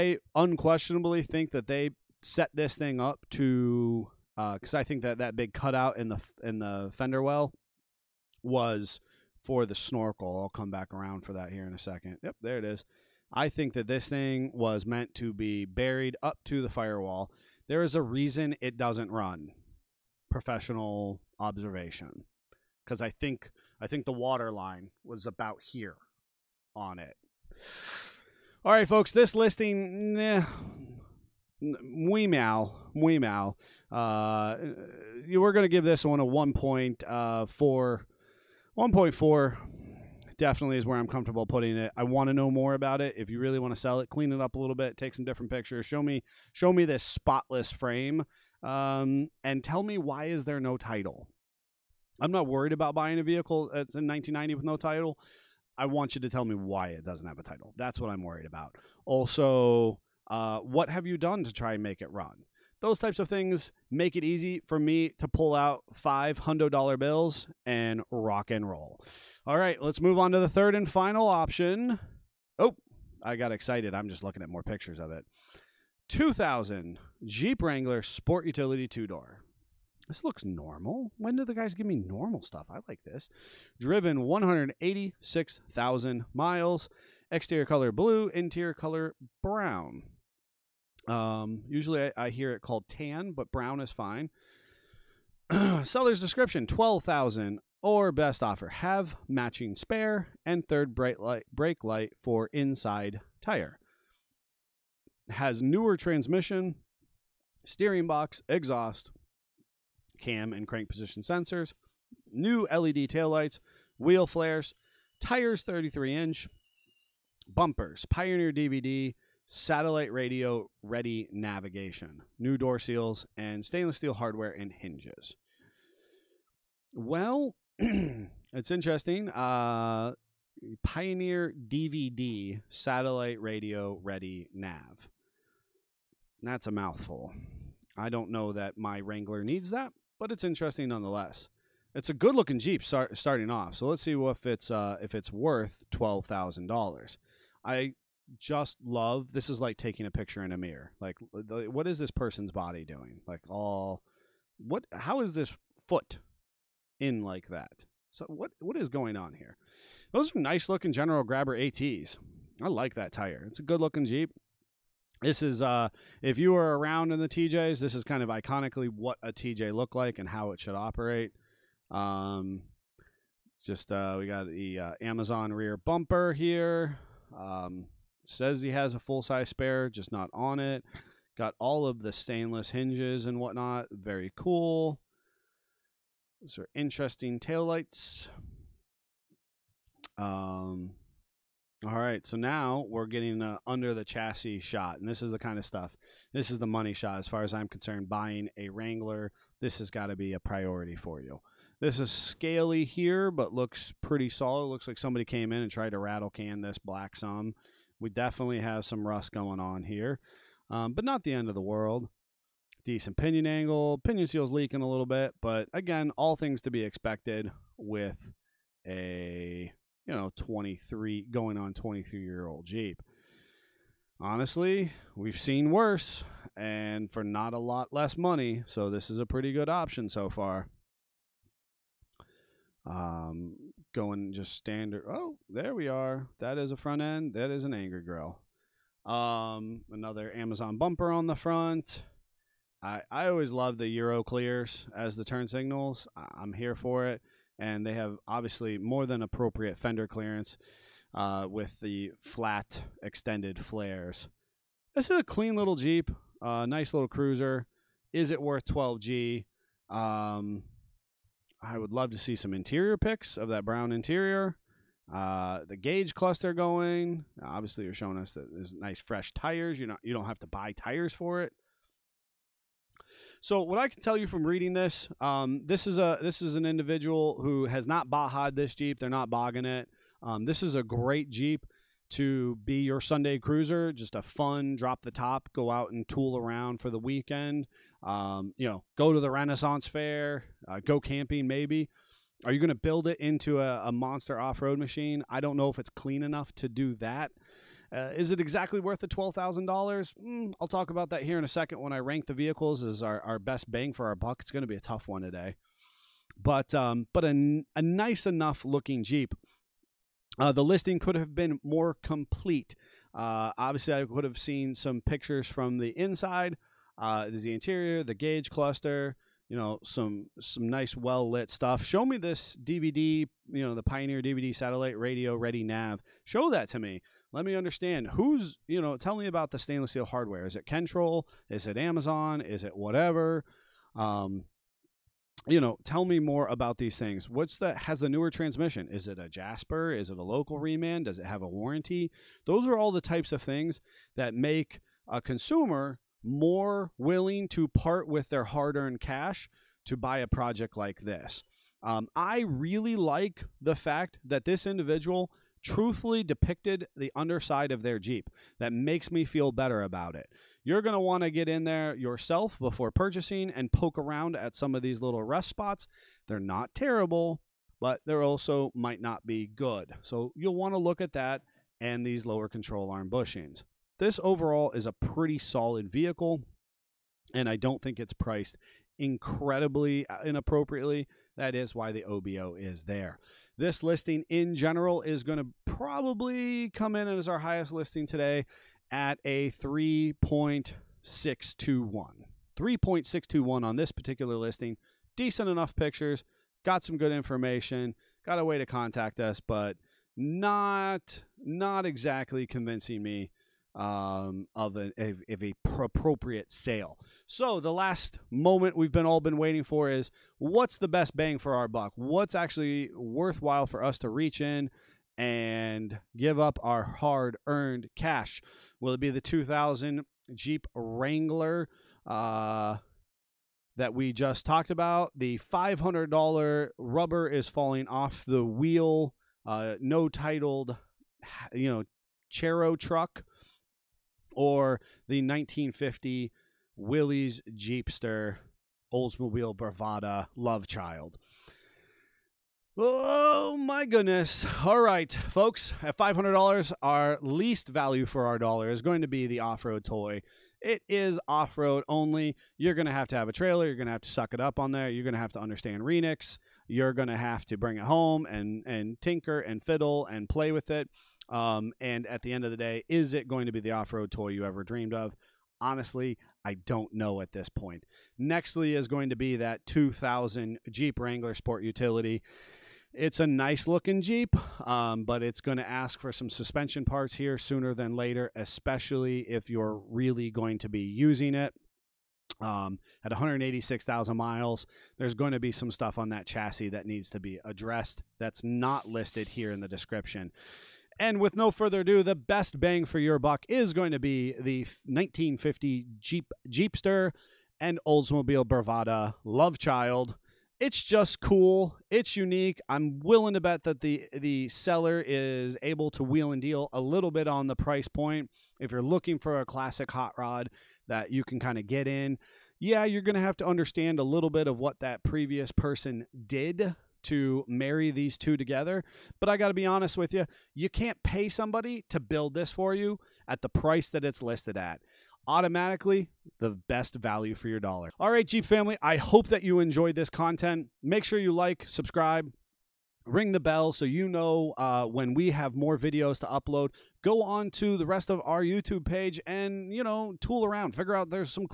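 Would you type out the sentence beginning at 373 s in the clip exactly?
This overall is a pretty solid vehicle, and I don't think it's priced incredibly uh, inappropriately.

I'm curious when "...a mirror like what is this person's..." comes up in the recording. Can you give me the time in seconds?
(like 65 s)
150 s.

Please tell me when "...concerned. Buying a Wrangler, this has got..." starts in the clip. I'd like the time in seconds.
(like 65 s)
197 s.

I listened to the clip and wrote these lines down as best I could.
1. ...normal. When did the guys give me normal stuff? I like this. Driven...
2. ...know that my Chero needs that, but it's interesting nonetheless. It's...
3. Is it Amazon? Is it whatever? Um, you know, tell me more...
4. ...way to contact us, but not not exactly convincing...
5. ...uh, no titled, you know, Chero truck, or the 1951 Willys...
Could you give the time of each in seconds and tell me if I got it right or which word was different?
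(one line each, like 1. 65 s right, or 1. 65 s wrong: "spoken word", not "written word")
1. 80 s right
2. 138 s wrong: "Wrangler", not "Chero"
3. 331 s right
4. 398 s right
5. 429 s wrong: "1950", not "1951".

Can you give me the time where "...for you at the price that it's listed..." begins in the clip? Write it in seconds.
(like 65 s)
522 s.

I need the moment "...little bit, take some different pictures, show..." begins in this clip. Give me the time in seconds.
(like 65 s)
44 s.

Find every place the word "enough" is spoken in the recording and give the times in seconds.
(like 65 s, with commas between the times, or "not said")
296 s, 308 s, 395 s.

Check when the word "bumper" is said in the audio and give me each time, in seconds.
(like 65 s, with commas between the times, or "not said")
117 s, 175 s, 240 s.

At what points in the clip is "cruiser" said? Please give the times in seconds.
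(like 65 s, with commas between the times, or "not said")
257 s, 283 s.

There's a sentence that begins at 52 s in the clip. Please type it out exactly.
I'm not worried about buying a vehicle that's in 1990 with no title.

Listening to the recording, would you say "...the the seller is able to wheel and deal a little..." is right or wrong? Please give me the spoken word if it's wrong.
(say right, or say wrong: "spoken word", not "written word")
right.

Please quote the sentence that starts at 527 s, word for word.
All right, Jeep family, I hope that you enjoyed this content.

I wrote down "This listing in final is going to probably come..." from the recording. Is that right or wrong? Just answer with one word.
wrong.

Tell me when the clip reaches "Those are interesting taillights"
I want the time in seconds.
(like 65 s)
186 s.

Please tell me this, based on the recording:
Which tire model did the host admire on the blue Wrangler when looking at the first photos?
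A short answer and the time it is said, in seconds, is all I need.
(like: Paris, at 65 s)
General Grabber ATs, at 160 s.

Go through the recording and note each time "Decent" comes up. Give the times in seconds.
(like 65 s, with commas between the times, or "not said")
212 s, 395 s.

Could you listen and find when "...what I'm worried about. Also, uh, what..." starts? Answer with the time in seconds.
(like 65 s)
58 s.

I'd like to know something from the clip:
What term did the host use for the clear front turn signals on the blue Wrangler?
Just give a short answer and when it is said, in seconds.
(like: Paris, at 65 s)
Euro clears, at 243 s.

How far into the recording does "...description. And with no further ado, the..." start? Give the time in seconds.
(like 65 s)
489 s.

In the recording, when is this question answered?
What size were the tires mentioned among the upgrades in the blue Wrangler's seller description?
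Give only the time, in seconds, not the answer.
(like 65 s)
115 s.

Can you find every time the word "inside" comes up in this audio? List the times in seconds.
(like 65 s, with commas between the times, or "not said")
102 s, 315 s.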